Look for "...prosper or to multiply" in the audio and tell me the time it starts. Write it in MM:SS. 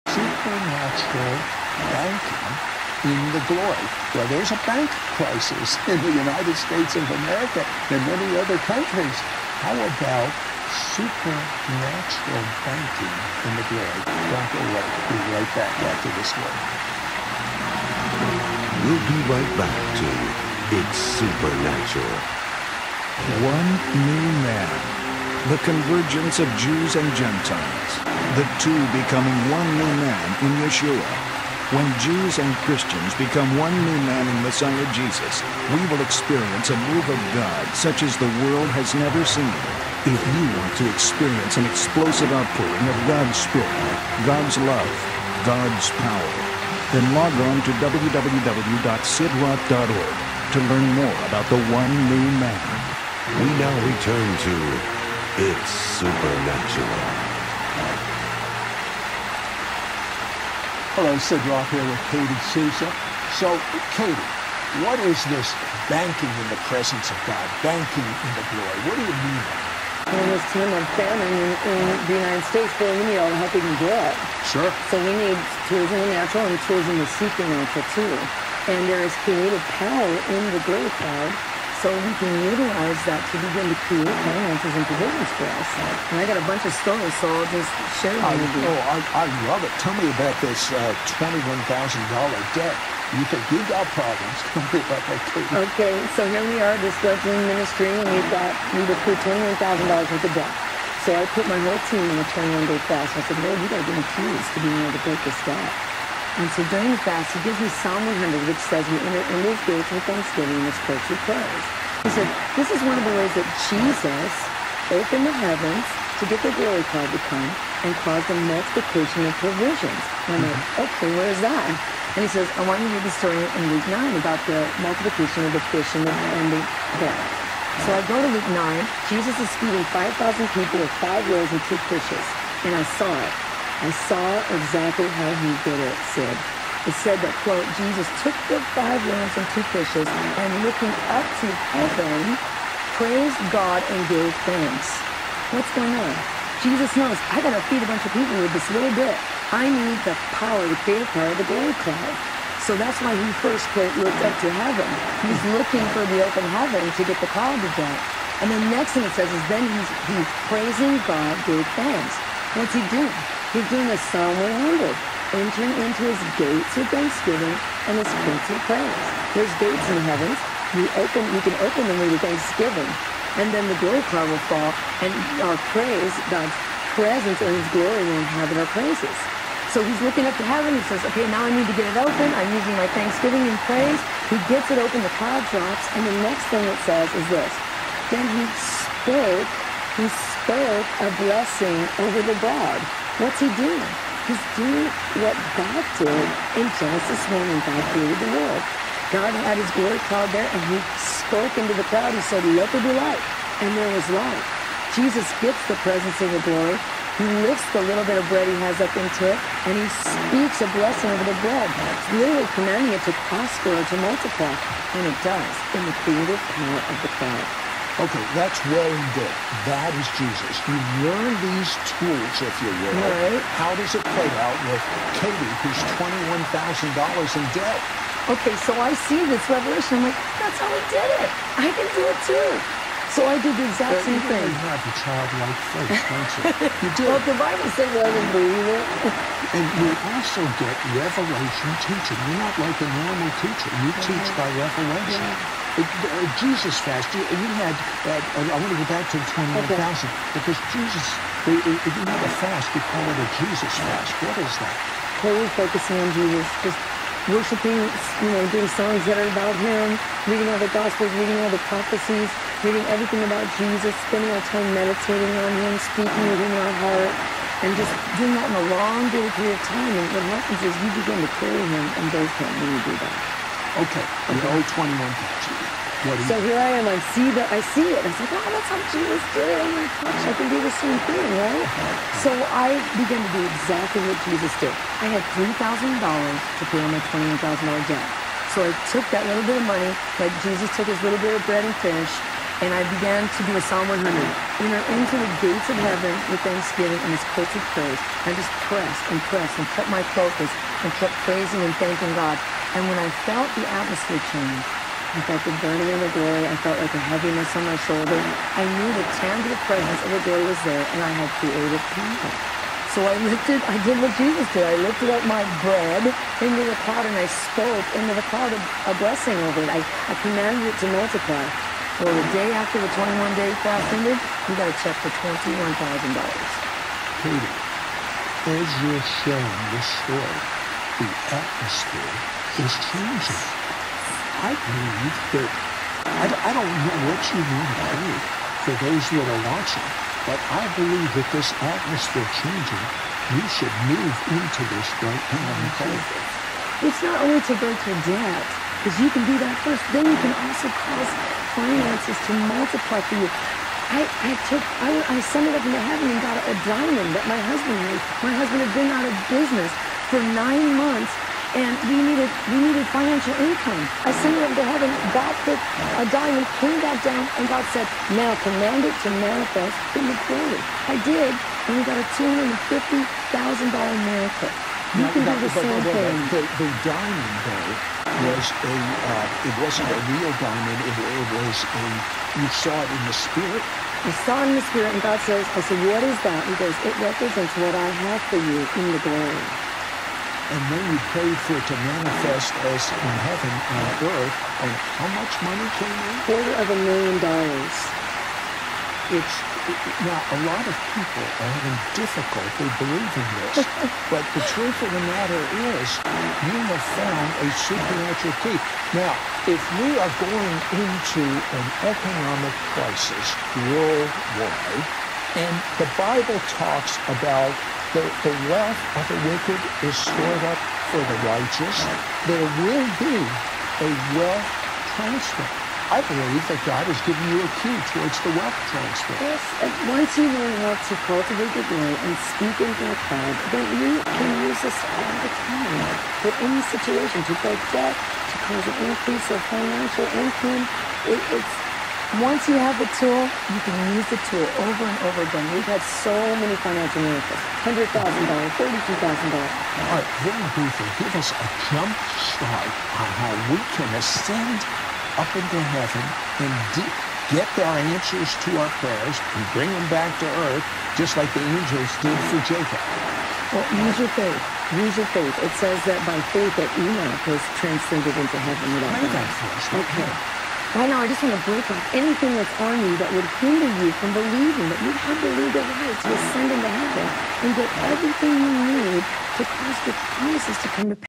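03:33.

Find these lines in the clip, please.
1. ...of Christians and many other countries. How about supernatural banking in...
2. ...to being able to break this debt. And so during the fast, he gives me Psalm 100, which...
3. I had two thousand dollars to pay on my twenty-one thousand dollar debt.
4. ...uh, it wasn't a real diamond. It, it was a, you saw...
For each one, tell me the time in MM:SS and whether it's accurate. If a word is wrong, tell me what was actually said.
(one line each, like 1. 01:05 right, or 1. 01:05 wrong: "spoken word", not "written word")
1. 00:06 wrong: "America", not "Christians"
2. 01:44 right
3. 04:45 wrong: "three", not "two"
4. 06:18 right.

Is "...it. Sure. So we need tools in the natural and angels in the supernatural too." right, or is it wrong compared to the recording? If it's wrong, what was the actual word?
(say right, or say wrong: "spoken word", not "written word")
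wrong: "tools", not "angels".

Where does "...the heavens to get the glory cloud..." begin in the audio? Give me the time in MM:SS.
01:55.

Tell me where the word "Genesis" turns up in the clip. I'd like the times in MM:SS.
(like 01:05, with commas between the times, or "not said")
03:16.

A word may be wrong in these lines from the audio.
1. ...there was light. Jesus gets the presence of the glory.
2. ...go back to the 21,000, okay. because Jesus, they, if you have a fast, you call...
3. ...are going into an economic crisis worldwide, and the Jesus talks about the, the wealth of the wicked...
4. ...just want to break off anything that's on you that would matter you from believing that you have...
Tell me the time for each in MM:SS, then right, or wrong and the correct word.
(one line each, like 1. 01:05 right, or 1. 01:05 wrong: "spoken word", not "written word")
1. 03:23 right
2. 04:08 right
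3. 06:50 wrong: "Bible", not "Jesus"
4. 07:51 wrong: "hinder", not "matter".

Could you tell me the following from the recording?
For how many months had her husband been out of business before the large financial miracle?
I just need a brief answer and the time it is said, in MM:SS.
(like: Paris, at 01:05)
9, at 06:00.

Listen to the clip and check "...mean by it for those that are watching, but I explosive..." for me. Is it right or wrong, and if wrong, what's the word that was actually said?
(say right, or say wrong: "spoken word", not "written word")
wrong: "believe", not "explosive".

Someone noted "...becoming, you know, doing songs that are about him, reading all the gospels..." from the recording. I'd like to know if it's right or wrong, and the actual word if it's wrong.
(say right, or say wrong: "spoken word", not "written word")
wrong: "worshiping", not "becoming".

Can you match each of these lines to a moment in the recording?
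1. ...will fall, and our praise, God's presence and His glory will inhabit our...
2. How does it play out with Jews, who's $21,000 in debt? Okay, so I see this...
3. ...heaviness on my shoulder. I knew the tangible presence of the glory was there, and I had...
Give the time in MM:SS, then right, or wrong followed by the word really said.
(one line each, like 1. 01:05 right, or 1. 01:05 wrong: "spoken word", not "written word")
1. 02:54 right
2. 03:43 wrong: "Katie", not "Jews"
3. 05:07 right.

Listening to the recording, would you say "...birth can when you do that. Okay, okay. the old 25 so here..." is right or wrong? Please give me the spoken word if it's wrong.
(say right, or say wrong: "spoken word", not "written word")
wrong: "21", not "25".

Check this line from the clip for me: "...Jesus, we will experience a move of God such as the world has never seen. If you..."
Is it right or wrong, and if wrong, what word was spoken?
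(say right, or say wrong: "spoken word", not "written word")
right.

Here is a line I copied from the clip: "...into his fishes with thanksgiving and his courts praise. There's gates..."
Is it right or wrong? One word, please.
wrong.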